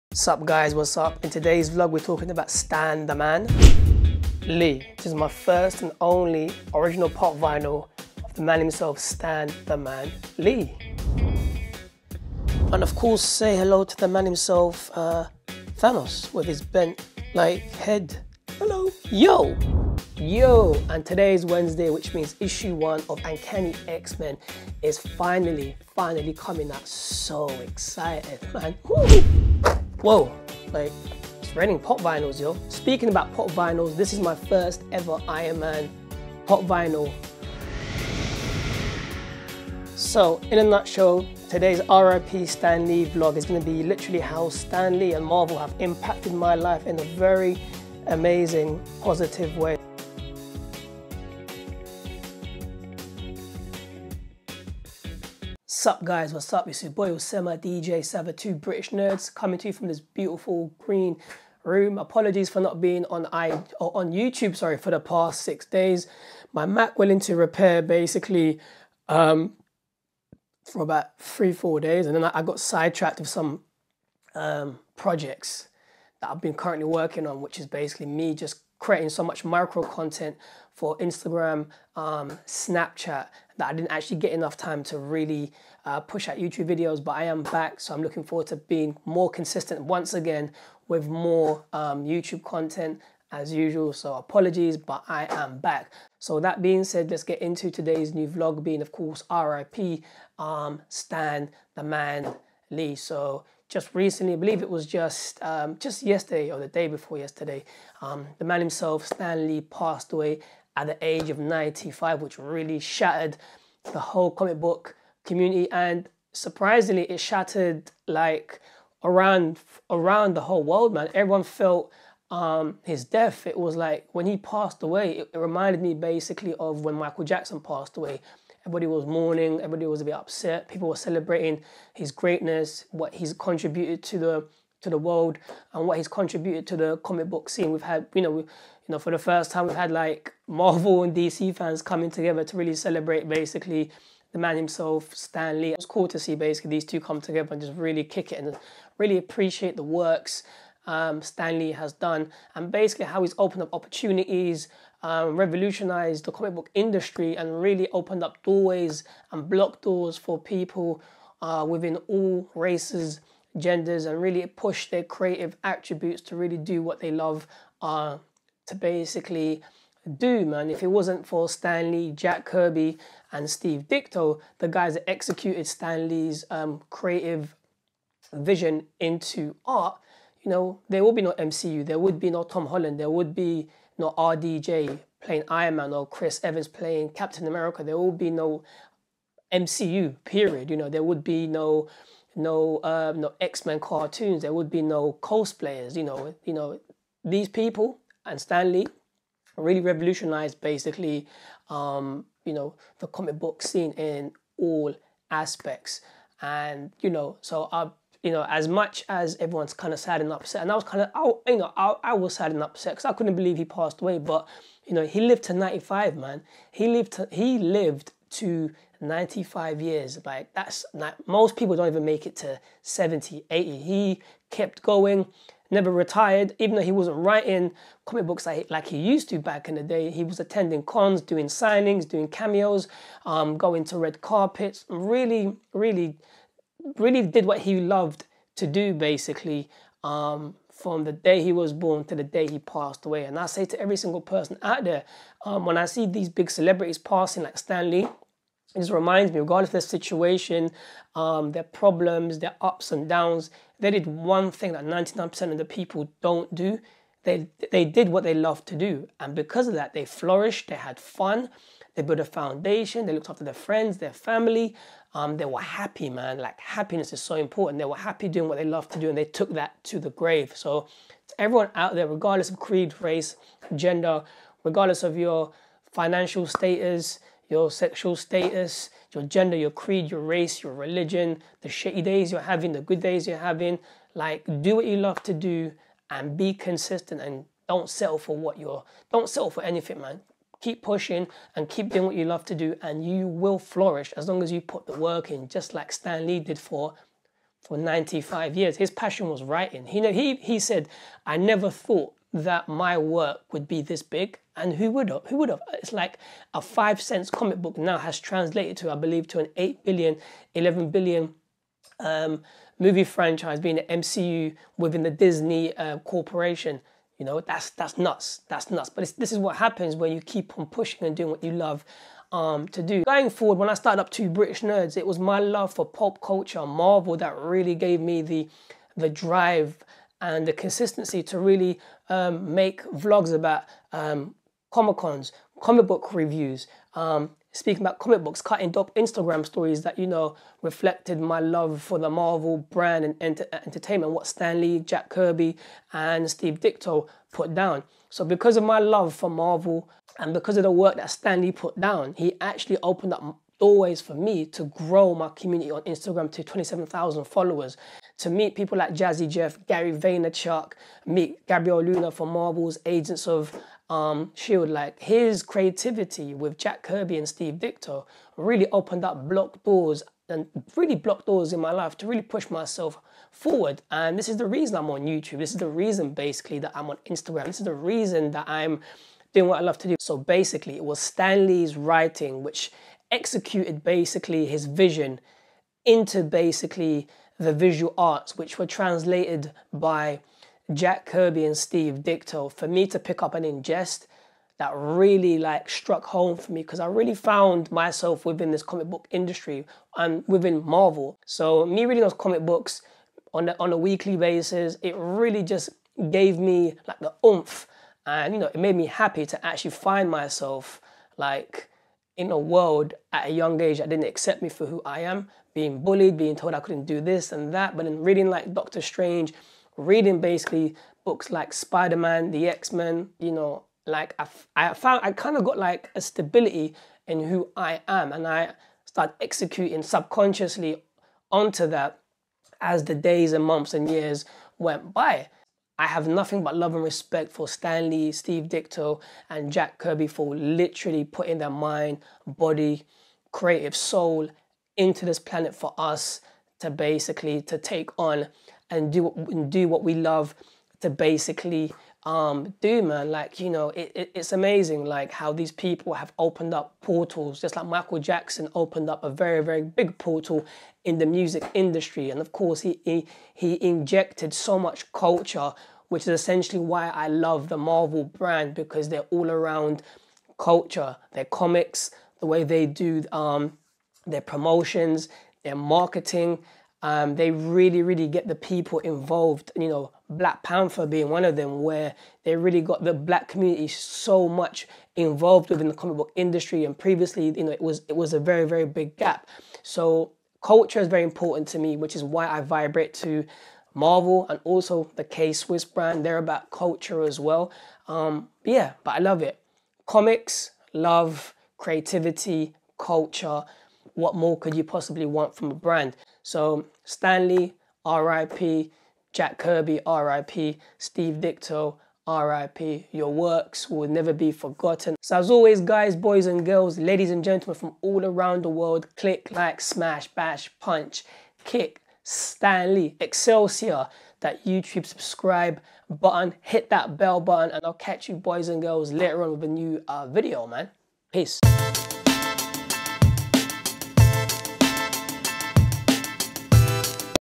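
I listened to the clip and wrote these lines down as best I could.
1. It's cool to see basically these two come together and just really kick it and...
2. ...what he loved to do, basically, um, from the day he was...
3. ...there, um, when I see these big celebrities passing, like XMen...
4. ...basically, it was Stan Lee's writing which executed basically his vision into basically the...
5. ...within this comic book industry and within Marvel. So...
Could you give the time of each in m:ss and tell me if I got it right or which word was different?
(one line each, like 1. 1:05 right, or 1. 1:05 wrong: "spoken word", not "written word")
1. 2:25 right
2. 3:57 right
3. 4:04 wrong: "Stan", not "XMen"
4. 6:20 right
5. 6:38 right.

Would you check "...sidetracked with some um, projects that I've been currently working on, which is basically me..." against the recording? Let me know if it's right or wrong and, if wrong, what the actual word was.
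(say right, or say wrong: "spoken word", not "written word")
right.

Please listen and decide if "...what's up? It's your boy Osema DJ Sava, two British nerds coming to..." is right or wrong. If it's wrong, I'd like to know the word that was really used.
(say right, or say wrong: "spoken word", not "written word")
right.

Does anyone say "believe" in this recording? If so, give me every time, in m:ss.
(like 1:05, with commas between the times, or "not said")
1:44, 3:33, 5:08.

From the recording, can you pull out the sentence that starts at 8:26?
So Stan Lee, RIP, Jack Kirby, RIP, Steve Ditko, RIP.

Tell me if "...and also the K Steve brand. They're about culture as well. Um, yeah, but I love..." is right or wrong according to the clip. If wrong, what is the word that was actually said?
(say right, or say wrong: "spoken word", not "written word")
wrong: "Swiss", not "Steve".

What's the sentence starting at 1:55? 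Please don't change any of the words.
And surprisingly, it shattered like around around the whole world, man.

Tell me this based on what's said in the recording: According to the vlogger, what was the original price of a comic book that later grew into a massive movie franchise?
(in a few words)
5 cents.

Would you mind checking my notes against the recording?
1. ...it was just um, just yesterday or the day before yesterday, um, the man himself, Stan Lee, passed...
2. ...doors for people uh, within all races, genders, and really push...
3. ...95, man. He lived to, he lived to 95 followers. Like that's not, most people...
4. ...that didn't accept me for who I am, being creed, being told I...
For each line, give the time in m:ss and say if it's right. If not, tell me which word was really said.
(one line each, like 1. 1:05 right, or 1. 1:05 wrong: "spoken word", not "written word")
1. 1:44 right
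2. 2:39 right
3. 3:35 wrong: "years", not "followers"
4. 6:53 wrong: "bullied", not "creed".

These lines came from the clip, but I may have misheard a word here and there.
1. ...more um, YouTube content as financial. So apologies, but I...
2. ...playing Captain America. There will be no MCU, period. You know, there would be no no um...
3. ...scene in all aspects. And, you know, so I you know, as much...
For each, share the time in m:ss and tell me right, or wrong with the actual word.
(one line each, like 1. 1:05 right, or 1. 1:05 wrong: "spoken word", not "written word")
1. 1:31 wrong: "usual", not "financial"
2. 3:06 right
3. 3:23 right.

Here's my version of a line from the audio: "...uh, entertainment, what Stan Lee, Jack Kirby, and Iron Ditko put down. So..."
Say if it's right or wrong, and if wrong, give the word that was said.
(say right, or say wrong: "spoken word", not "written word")
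wrong: "Steve", not "Iron".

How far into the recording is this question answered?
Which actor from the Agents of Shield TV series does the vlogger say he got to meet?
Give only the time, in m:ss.
6:01.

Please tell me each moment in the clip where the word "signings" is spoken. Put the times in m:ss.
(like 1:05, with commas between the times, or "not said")
3:51.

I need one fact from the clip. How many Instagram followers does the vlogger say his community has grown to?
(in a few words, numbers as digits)
27,000.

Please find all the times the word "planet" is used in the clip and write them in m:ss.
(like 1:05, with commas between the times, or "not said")
7:25.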